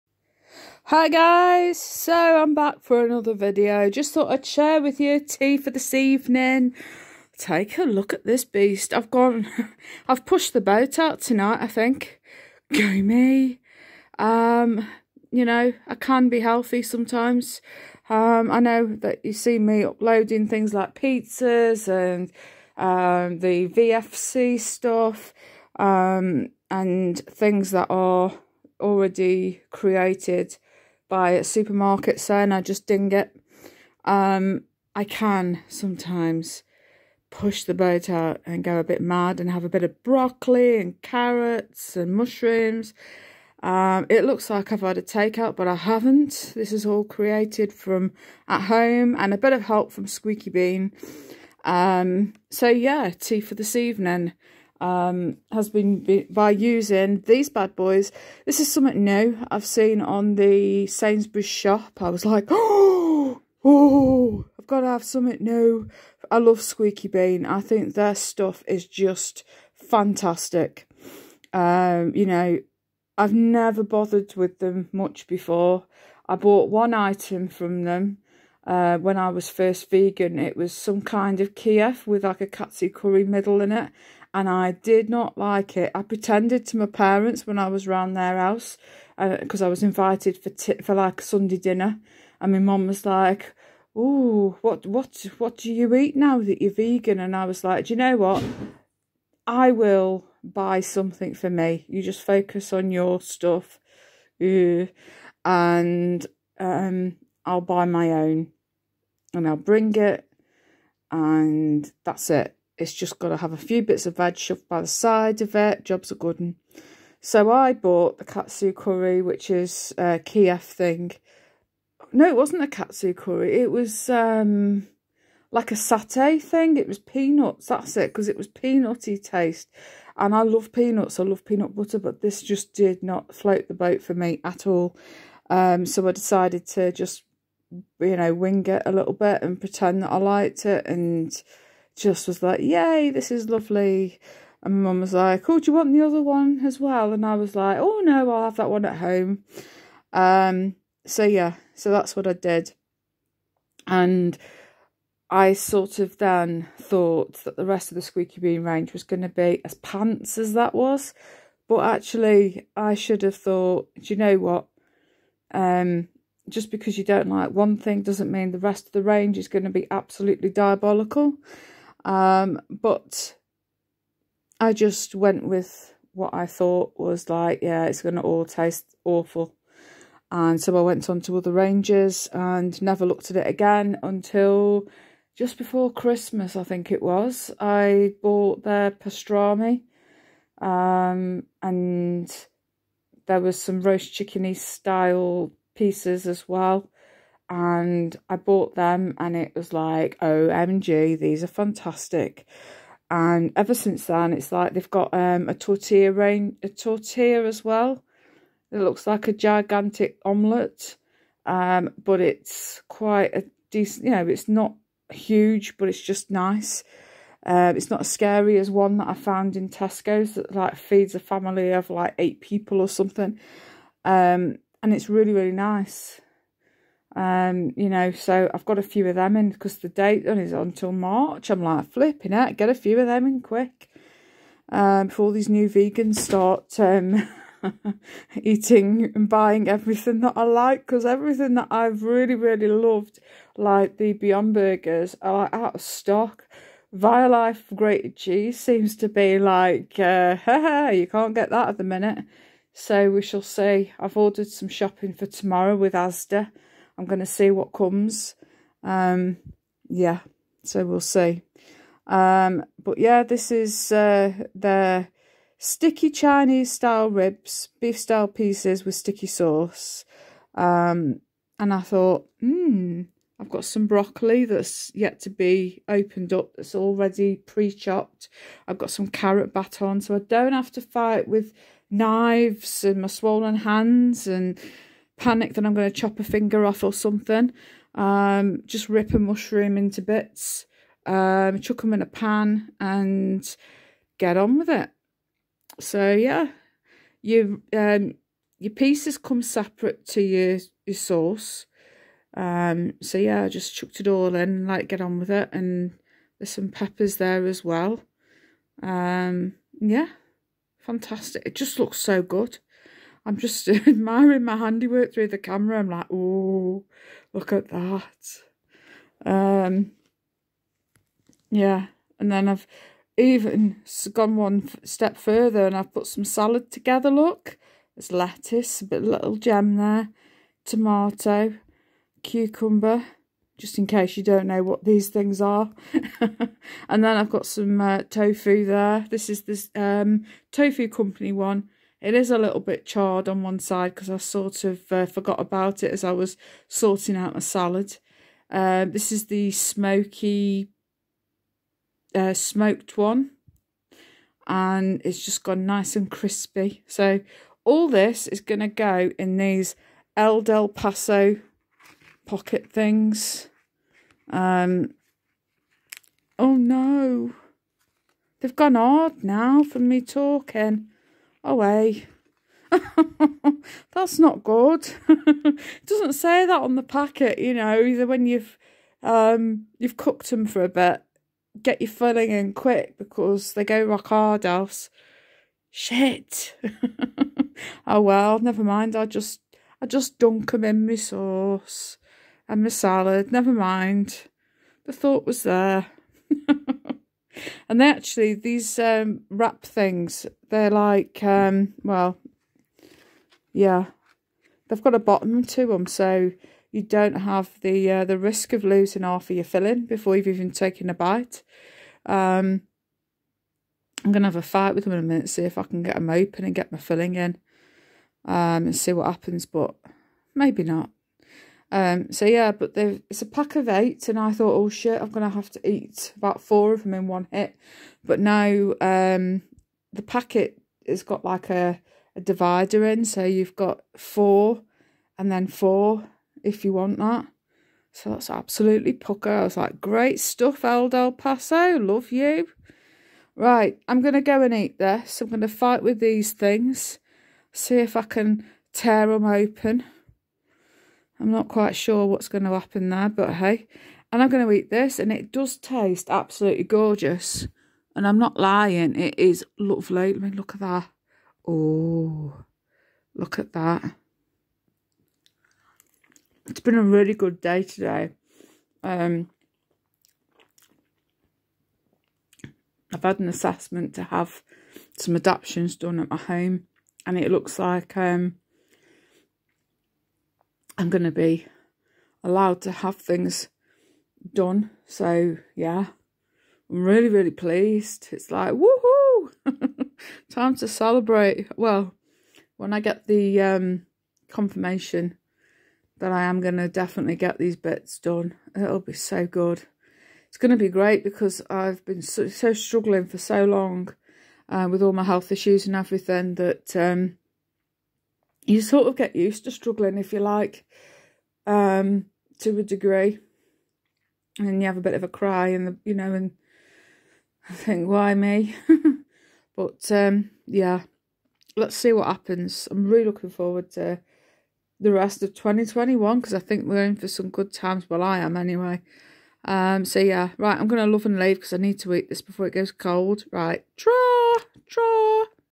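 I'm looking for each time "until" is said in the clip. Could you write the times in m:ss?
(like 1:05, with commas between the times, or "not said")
3:04, 3:50.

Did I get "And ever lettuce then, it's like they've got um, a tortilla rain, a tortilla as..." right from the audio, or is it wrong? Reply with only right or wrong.
wrong.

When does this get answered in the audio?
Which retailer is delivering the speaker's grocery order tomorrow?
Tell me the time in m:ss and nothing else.
4:15.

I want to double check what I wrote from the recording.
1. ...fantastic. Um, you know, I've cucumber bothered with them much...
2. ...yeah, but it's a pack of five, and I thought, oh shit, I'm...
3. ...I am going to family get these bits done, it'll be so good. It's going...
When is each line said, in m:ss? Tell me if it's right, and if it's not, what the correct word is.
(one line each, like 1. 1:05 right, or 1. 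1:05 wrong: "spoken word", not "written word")
1. 1:09 wrong: "never", not "cucumber"
2. 7:02 wrong: "eight", not "five"
3. 8:16 wrong: "definitely", not "family".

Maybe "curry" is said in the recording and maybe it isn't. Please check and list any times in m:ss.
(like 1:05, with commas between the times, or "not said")
1:22, 1:58, 2:03.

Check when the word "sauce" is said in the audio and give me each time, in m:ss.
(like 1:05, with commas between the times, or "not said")
4:29, 5:00, 6:30.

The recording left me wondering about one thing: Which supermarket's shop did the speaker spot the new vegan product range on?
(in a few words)
Sainsbury's.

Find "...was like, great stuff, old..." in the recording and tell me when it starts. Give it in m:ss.
7:19.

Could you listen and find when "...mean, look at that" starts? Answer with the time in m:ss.
7:40.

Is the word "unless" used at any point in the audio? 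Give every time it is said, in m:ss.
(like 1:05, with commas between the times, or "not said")
not said.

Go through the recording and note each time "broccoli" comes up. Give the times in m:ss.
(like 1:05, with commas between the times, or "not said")
0:40, 4:33.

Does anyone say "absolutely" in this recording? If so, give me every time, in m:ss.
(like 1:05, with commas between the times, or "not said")
2:49, 7:18, 7:36.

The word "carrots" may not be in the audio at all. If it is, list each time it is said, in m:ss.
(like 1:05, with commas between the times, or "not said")
0:41, 4:39.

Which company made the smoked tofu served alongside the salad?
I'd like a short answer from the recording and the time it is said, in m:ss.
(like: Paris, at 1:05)
Tofoo Company, at 5:40.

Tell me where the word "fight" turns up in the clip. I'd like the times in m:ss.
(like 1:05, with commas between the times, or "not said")
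4:40, 6:54, 7:25.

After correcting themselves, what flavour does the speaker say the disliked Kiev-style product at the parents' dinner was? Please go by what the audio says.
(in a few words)
Satay.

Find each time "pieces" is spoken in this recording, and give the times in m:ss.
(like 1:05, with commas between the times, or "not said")
3:15, 4:28, 4:58.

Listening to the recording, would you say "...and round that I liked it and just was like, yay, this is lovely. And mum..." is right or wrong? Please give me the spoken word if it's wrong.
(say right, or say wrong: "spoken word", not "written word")
wrong: "pretend", not "round".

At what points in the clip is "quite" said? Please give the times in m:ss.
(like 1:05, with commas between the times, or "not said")
3:32, 7:31.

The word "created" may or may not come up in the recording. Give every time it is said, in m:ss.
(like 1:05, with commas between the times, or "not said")
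0:29, 0:47.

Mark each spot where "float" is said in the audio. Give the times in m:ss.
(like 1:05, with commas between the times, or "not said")
2:13.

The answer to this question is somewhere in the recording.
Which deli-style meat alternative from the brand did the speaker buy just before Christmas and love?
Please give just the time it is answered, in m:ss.
3:08.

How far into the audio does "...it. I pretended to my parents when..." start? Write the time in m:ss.
1:25.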